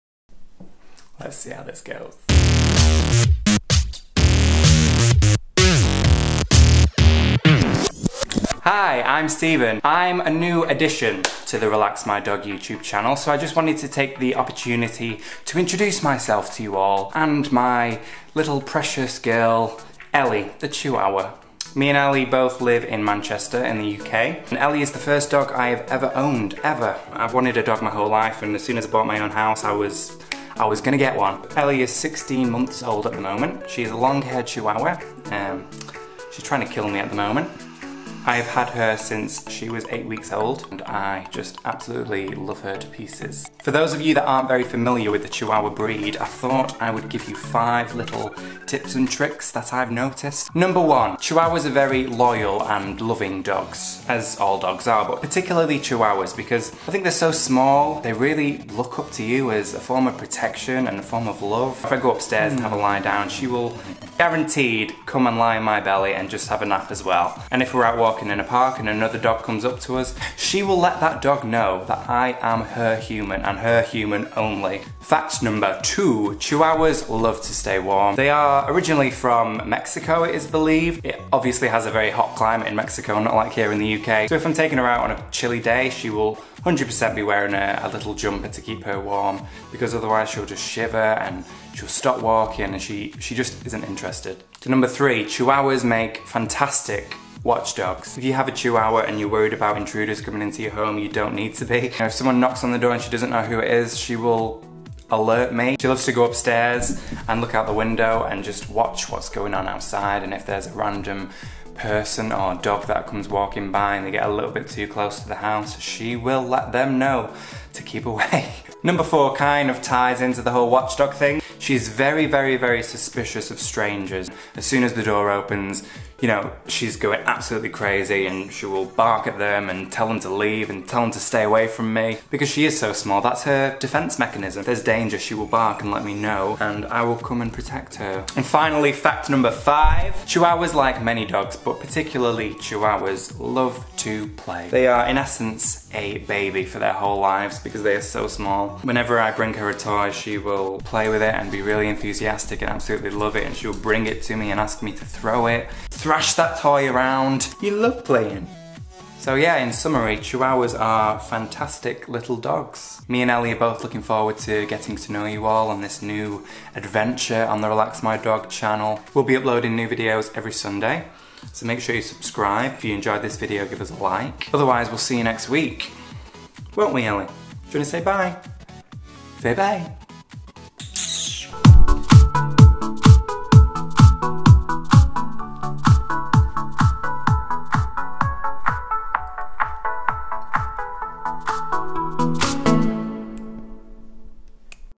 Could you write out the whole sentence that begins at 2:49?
We'll be uploading new videos every Sunday, so make sure you subscribe.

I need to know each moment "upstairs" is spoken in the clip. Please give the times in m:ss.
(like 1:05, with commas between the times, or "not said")
1:02, 1:46.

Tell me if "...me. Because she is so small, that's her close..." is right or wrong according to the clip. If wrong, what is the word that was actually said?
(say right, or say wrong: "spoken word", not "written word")
wrong: "defense", not "close".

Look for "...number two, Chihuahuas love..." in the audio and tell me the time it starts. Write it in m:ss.
1:15.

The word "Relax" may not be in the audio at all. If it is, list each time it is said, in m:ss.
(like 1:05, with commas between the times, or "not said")
0:11, 2:47.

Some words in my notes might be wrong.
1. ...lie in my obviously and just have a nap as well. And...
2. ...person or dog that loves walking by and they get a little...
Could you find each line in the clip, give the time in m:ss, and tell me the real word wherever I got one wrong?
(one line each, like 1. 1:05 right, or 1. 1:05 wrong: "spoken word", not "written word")
1. 1:05 wrong: "belly", not "obviously"
2. 1:51 wrong: "comes", not "loves".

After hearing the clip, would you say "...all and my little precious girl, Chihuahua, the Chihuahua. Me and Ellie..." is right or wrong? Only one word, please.
wrong.